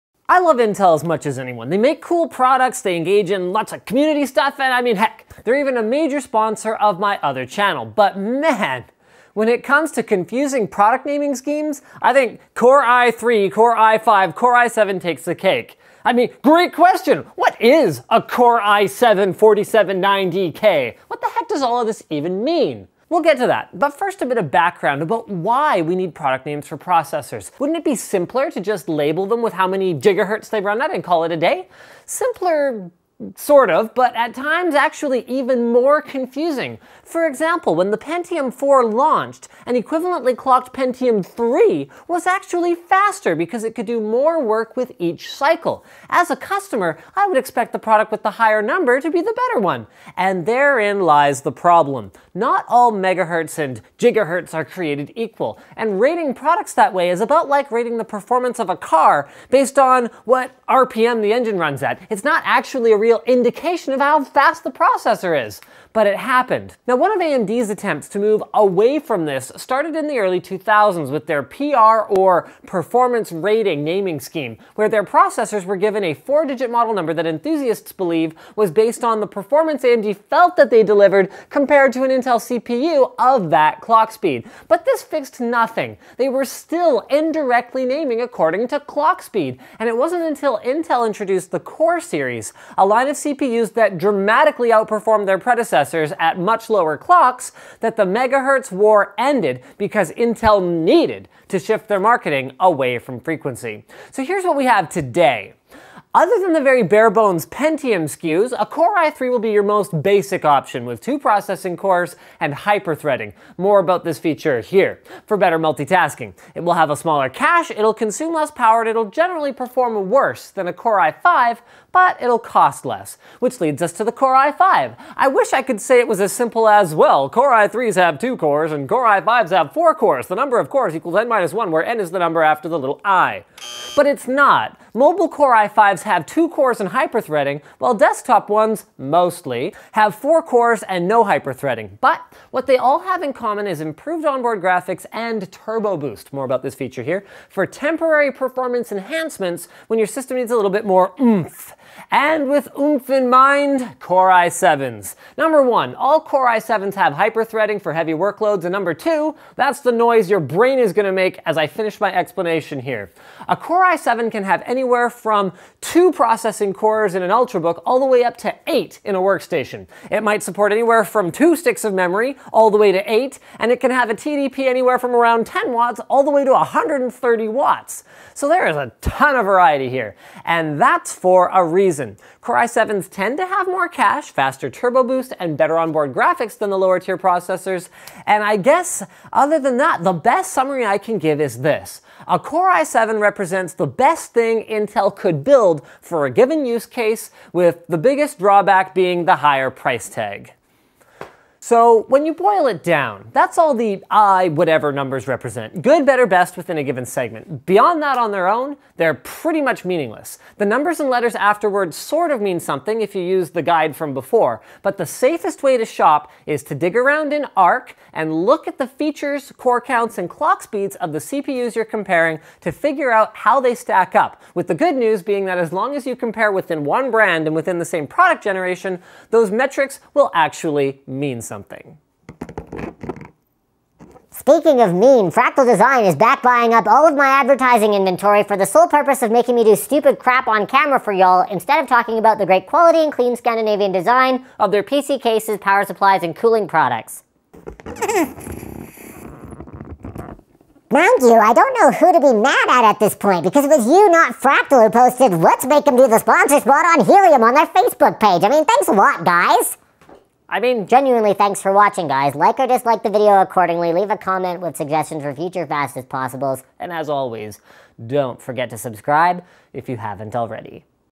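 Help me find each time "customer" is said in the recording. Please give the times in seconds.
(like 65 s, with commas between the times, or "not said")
46 s.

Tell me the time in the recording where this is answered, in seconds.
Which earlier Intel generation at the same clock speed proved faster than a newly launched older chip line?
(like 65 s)
40 s.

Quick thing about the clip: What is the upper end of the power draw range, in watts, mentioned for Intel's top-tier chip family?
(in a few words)
130 watts.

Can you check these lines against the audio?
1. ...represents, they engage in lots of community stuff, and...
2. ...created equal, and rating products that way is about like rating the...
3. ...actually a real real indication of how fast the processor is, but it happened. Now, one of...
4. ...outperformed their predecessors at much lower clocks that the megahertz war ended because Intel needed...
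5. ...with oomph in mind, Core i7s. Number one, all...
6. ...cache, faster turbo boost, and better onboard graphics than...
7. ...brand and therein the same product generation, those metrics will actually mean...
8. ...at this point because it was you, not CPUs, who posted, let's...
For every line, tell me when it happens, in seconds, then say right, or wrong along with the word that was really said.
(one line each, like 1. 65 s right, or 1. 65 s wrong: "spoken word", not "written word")
1. 2 s wrong: "products", not "represents"
2. 54 s right
3. 62 s right
4. 94 s right
5. 152 s right
6. 183 s right
7. 227 s wrong: "within", not "therein"
8. 252 s wrong: "Fractal", not "CPUs".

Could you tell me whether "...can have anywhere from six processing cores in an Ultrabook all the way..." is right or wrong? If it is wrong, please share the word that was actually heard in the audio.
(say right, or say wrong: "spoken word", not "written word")
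wrong: "two", not "six".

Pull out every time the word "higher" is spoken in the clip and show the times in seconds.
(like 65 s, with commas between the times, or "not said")
48 s, 199 s.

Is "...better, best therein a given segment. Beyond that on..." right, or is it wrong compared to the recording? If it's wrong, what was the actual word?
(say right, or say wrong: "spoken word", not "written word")
wrong: "within", not "therein".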